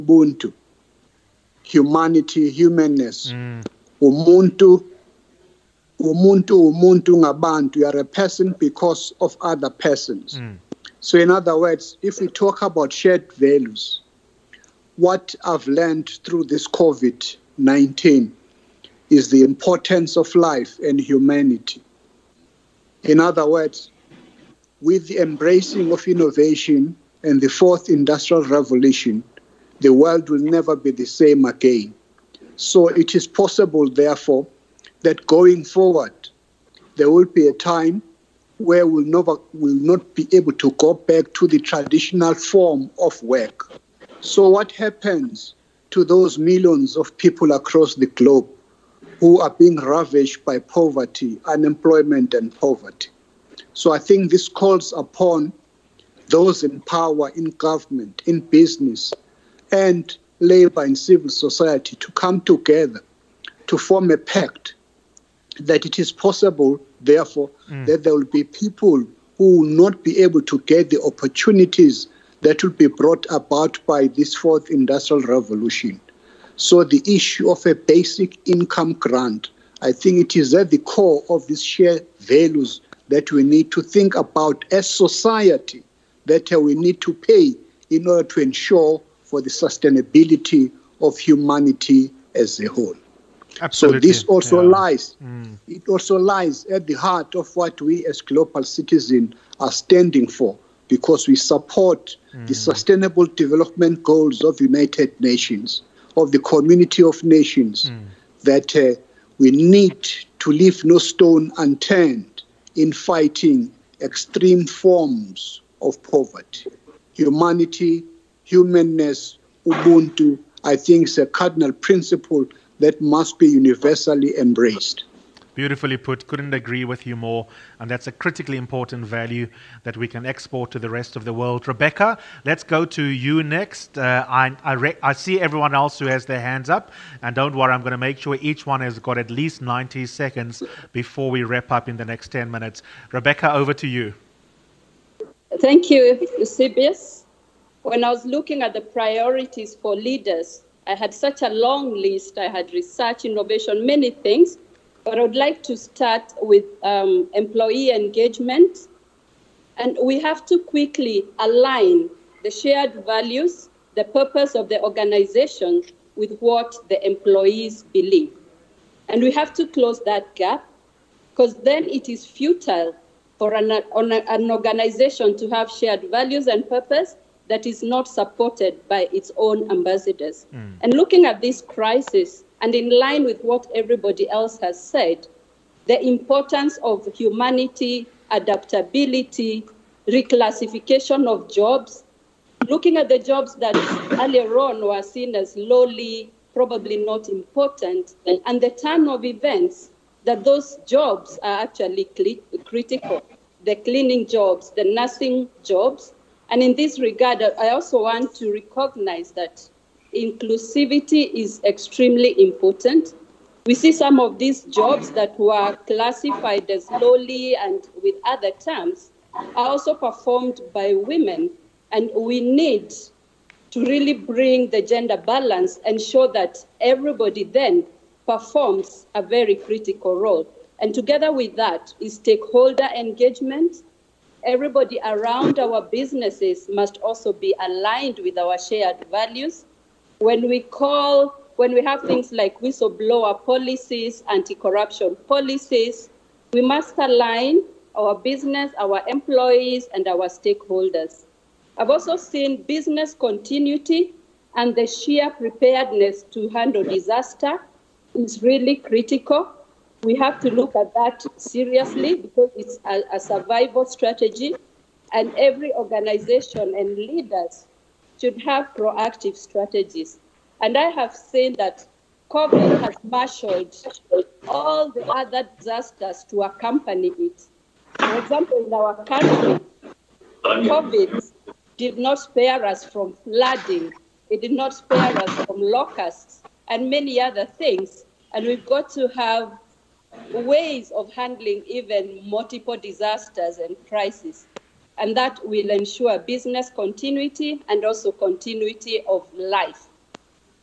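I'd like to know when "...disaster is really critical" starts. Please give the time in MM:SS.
04:16.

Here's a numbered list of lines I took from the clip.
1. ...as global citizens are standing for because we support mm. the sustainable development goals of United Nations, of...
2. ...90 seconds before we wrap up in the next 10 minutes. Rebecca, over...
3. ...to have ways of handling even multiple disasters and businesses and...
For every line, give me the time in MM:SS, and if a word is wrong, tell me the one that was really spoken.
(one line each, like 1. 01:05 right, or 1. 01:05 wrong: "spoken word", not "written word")
1. 01:38 right
2. 02:19 right
3. 04:48 wrong: "crises", not "businesses".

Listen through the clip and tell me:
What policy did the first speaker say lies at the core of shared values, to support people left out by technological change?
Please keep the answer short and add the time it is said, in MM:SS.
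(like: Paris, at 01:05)
basic income grant, at 01:17.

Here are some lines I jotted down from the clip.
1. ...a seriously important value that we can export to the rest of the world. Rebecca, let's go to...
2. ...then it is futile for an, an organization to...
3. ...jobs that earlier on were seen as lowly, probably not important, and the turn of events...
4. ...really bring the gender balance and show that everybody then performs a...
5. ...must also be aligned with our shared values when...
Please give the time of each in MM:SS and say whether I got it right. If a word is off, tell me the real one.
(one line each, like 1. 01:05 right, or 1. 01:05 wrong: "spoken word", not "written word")
1. 02:08 wrong: "critically", not "seriously"
2. 02:51 right
3. 03:13 right
4. 03:43 right
5. 03:56 right.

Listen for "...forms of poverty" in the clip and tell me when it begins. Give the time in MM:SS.
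01:54.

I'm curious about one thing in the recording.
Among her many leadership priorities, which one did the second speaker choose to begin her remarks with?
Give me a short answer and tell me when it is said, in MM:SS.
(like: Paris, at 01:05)
employee engagement, at 02:37.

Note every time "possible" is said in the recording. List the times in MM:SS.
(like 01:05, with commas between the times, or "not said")
00:33, 01:06.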